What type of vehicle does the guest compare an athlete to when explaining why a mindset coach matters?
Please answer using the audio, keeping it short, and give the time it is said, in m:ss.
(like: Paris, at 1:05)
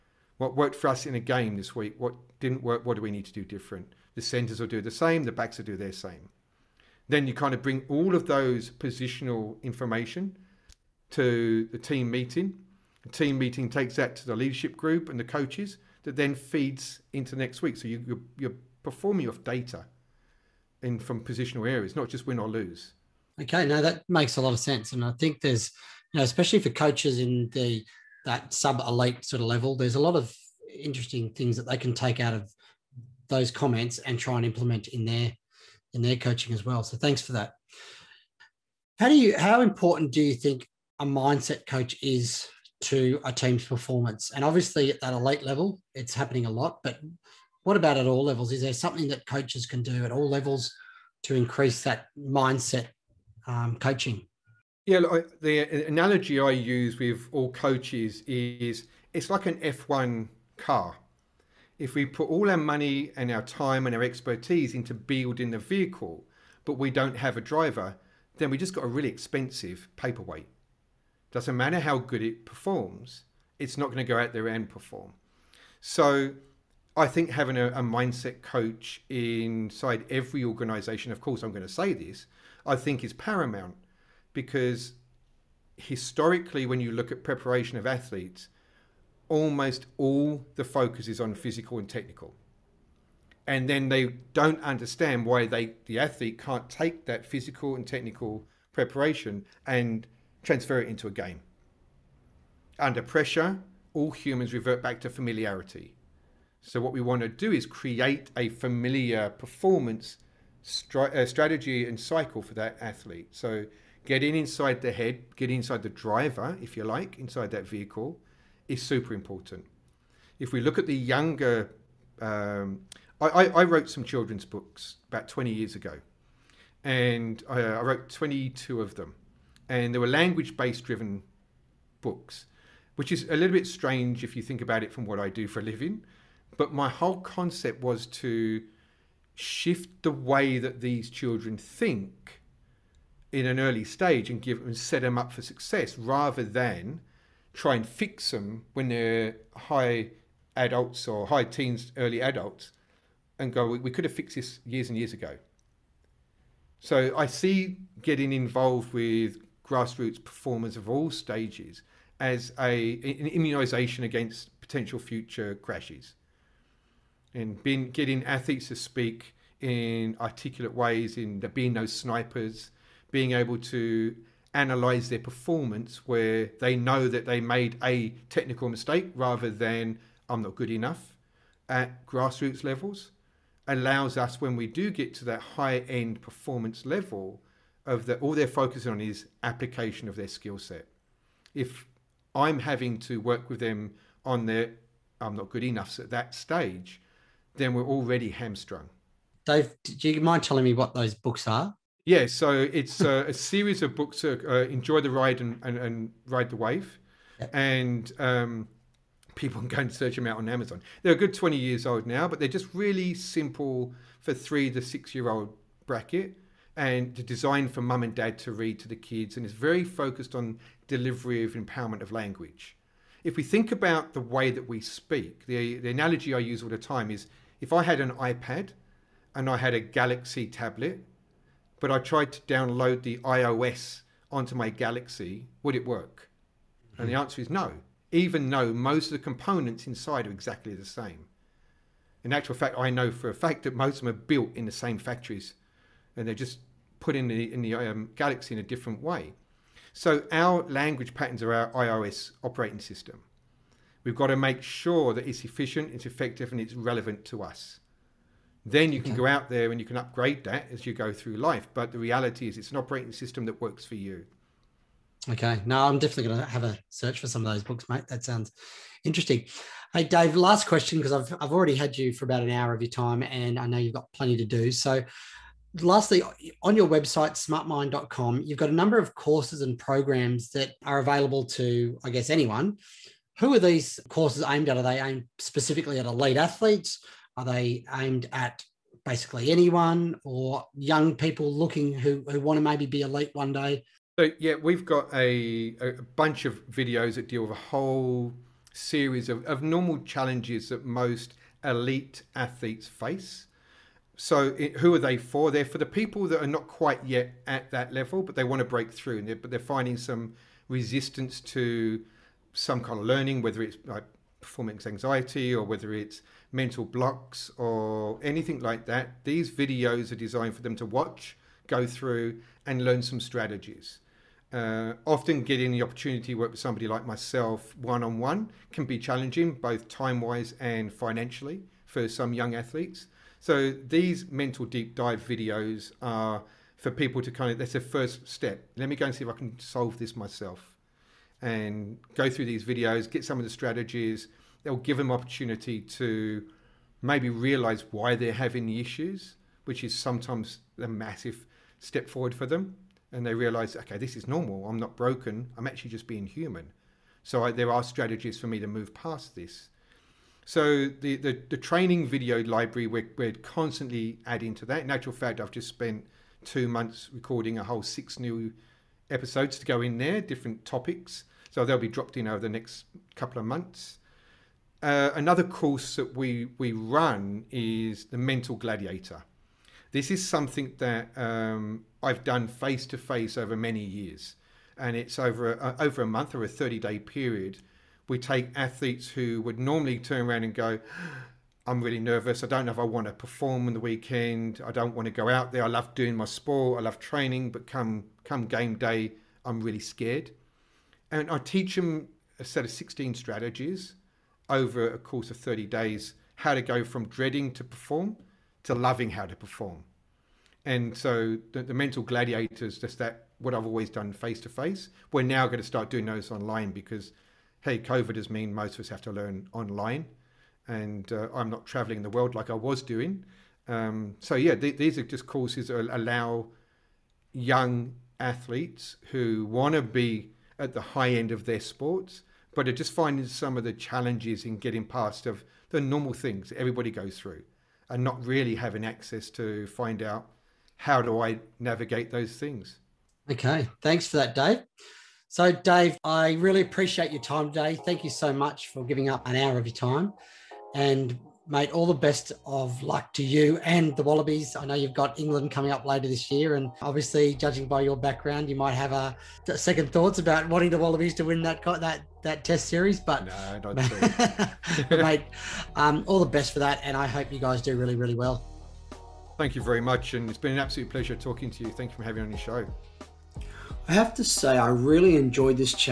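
F1 car, at 0:59.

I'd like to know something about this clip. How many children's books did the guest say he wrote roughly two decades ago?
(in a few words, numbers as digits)
22.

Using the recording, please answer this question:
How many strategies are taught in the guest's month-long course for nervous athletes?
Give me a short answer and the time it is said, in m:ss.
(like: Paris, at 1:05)
16, at 6:42.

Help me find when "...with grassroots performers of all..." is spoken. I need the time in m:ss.
2:38.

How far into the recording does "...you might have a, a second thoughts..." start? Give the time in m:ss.
7:38.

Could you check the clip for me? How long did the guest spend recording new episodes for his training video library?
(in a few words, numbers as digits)
2 months.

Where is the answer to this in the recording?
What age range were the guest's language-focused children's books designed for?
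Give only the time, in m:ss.
3:34.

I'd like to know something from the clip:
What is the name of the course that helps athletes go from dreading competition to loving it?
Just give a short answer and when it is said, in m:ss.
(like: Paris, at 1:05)
Mental Gladiator, at 6:18.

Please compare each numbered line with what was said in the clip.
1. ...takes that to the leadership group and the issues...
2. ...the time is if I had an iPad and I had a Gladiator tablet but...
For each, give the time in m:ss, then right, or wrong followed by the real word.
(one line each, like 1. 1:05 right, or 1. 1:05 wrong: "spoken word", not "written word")
1. 0:13 wrong: "coaches", not "issues"
2. 3:46 wrong: "Galaxy", not "Gladiator".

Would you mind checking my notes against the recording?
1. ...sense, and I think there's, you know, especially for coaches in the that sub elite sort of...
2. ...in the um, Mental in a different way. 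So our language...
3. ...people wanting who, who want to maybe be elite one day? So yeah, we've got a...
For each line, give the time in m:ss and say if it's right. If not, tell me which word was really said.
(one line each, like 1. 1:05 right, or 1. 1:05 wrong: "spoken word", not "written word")
1. 0:24 right
2. 4:07 wrong: "Galaxy", not "Mental"
3. 4:51 wrong: "looking", not "wanting".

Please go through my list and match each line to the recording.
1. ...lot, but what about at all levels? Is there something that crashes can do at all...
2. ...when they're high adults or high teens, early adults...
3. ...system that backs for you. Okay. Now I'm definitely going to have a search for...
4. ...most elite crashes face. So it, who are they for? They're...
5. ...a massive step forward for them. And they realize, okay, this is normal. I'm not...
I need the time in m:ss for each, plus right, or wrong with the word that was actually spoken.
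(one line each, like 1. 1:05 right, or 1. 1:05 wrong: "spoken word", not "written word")
1. 0:46 wrong: "coaches", not "crashes"
2. 2:28 right
3. 4:23 wrong: "works", not "backs"
4. 5:00 wrong: "athletes", not "crashes"
5. 5:50 right.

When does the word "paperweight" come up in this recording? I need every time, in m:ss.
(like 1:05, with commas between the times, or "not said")
1:09.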